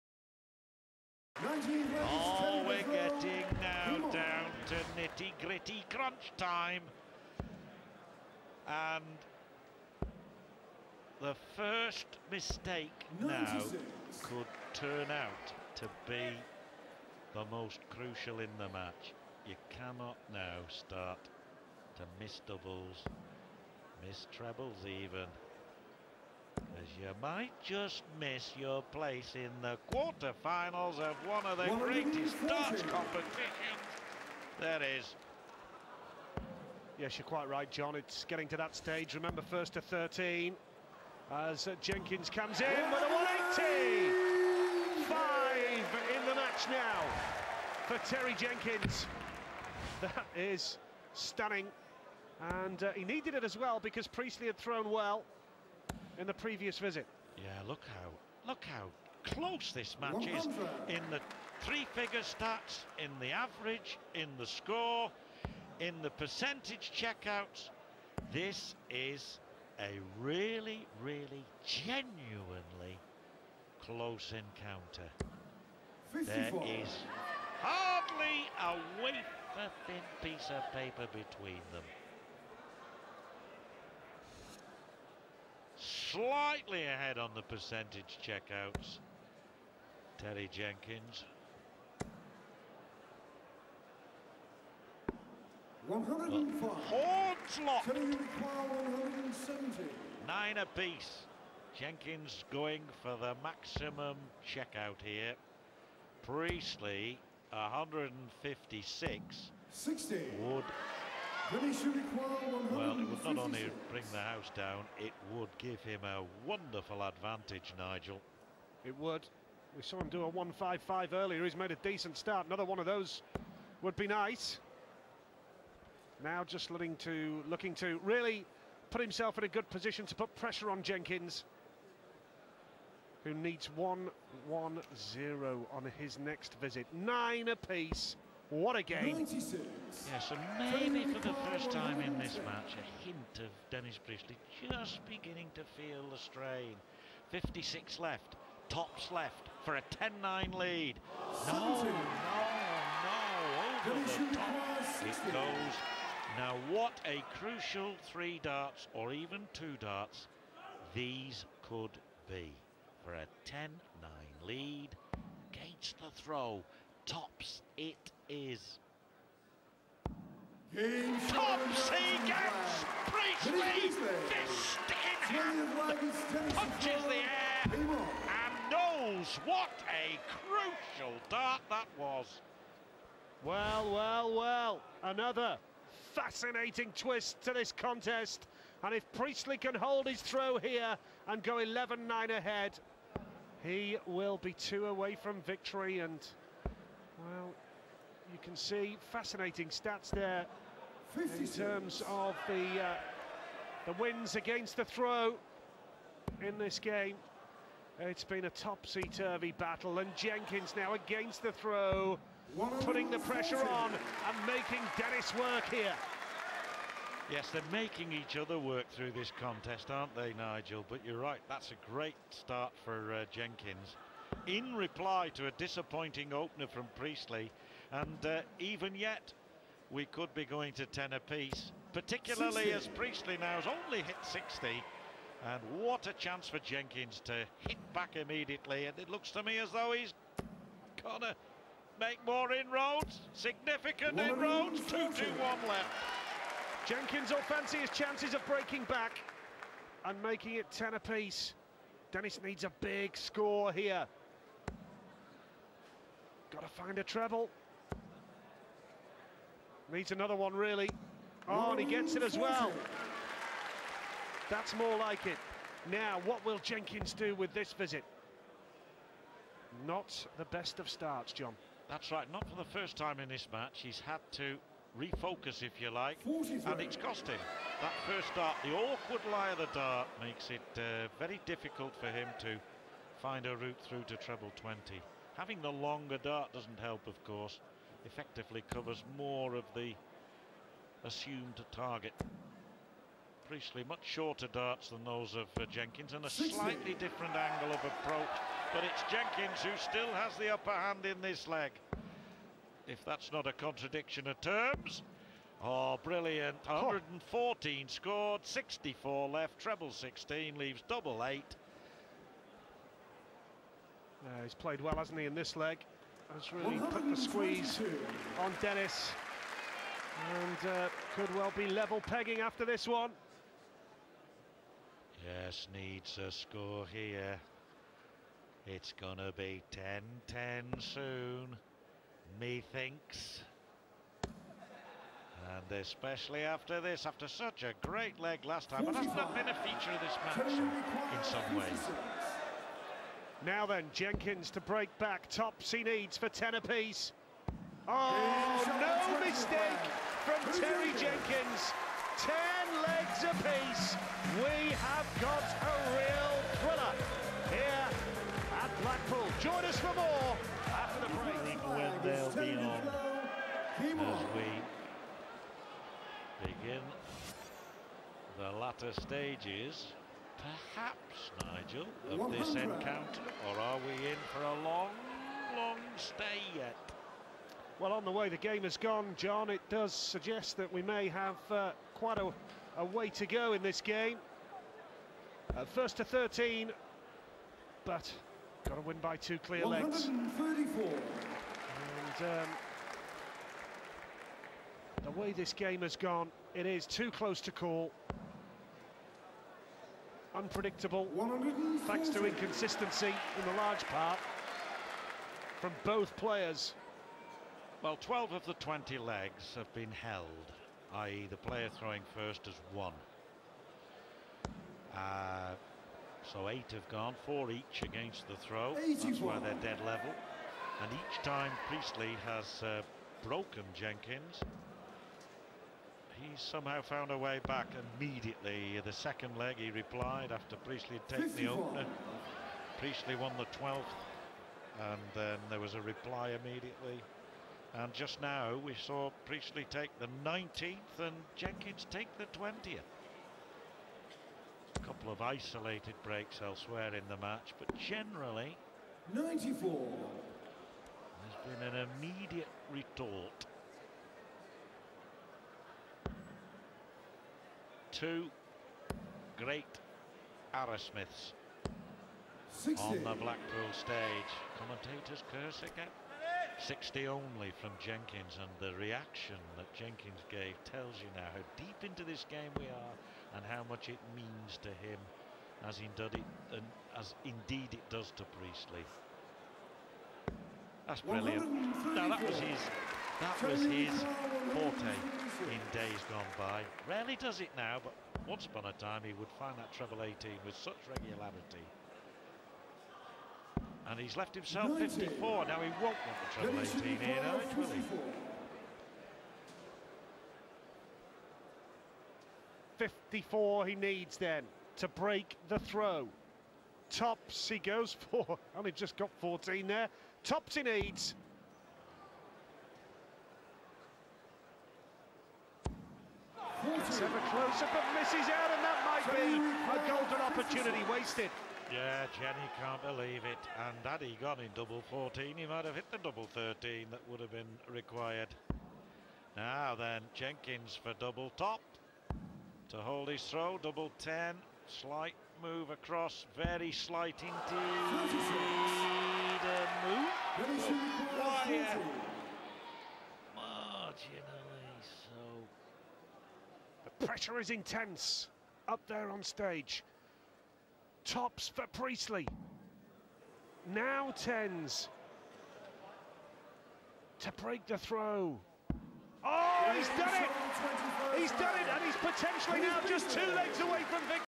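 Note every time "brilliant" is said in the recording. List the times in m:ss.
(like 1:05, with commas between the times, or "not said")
5:06, 8:01.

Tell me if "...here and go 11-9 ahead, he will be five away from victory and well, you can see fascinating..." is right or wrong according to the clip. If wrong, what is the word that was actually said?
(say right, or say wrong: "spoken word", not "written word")
wrong: "two", not "five".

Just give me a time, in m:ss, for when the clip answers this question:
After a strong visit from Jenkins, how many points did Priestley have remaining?
4:04.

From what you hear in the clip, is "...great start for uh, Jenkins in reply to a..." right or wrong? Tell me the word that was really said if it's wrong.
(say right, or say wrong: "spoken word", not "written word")
right.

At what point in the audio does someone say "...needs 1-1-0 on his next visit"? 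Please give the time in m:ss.
2:13.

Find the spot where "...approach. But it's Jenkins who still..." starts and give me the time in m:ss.
4:57.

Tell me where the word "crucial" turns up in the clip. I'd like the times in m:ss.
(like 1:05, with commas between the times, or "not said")
0:17, 2:37, 3:00.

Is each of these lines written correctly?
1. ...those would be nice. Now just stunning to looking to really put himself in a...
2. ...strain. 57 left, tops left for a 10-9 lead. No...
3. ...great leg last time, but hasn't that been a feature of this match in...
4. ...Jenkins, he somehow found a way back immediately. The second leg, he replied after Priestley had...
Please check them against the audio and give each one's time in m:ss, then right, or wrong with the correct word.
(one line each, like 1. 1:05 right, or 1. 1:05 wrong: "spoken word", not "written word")
1. 2:02 wrong: "looking", not "stunning"
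2. 2:26 wrong: "56", not "57"
3. 5:37 right
4. 7:03 right.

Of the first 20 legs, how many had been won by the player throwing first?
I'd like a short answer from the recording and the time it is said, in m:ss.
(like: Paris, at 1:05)
12, at 6:48.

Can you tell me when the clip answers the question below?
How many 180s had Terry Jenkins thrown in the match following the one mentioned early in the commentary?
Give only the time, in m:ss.
0:45.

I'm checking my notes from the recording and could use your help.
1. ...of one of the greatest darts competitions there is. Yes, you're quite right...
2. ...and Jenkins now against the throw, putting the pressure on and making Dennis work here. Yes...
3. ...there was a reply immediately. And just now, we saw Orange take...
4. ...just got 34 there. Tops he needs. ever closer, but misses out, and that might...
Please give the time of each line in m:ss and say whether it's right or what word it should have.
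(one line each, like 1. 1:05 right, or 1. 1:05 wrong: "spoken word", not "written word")
1. 0:30 right
2. 3:29 right
3. 7:15 wrong: "Priestley", not "Orange"
4. 8:28 wrong: "14", not "34".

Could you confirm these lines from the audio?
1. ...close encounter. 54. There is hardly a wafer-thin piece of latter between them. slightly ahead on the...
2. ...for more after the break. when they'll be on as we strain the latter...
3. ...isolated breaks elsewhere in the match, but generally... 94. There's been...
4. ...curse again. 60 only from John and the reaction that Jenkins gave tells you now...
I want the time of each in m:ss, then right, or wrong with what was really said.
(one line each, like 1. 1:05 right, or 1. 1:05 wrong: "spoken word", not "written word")
1. 1:13 wrong: "paper", not "latter"
2. 5:59 wrong: "begin", not "strain"
3. 7:25 right
4. 7:45 wrong: "Jenkins", not "John".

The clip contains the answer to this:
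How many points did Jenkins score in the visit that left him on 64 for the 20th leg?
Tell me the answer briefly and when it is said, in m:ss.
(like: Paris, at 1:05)
114, at 5:06.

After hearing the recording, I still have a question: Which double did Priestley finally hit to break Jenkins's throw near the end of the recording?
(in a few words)
Tens.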